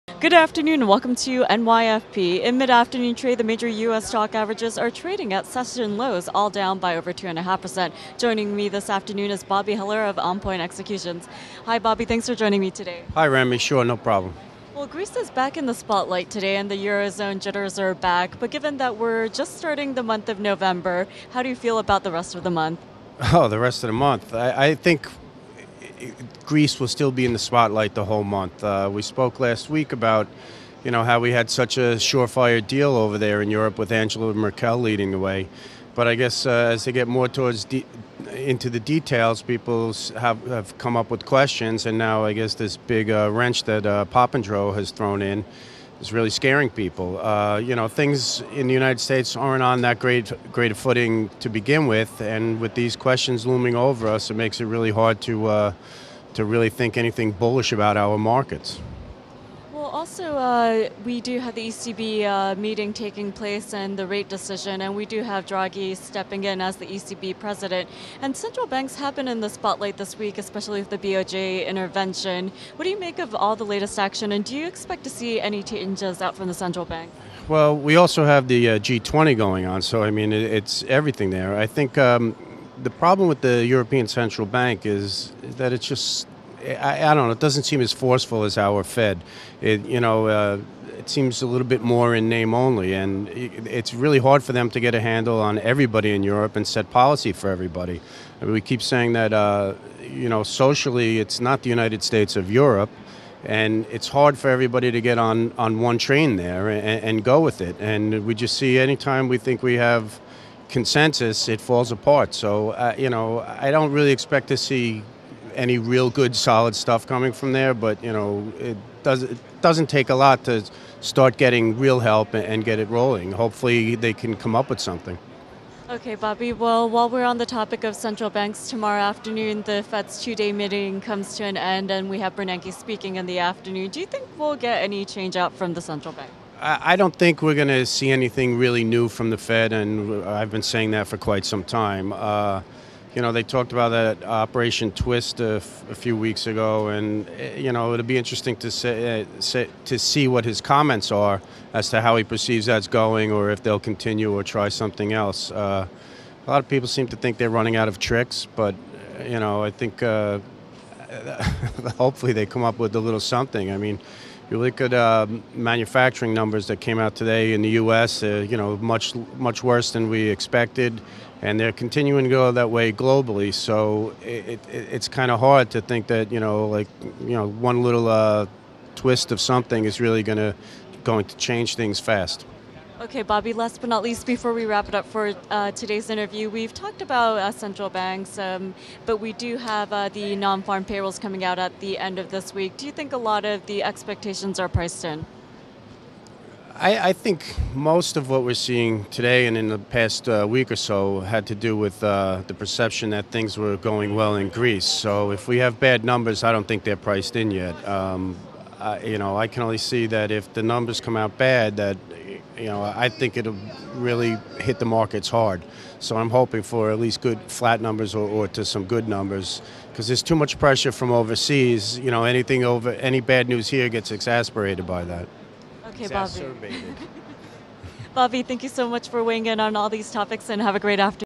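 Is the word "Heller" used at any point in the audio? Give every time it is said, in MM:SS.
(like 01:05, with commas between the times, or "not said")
00:09.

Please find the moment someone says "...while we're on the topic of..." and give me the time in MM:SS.
02:06.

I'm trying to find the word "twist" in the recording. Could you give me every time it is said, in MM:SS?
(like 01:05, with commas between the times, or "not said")
02:24, 02:58.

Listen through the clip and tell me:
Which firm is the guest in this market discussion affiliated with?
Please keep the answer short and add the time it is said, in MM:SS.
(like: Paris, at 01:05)
OnPoint Executions, at 00:10.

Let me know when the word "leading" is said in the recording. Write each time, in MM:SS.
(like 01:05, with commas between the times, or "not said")
00:34.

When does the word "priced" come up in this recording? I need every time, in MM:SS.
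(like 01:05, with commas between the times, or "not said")
03:14, 03:26.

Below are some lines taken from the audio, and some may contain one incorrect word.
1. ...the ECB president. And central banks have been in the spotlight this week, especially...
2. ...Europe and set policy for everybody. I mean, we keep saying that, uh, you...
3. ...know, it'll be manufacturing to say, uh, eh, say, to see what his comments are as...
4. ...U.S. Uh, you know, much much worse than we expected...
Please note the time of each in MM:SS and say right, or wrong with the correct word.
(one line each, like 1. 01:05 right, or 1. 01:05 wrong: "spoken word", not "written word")
1. 01:06 right
2. 01:36 right
3. 02:27 wrong: "interesting", not "manufacturing"
4. 02:47 right.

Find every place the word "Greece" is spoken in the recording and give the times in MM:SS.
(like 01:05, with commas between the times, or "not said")
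00:14, 00:26, 03:24.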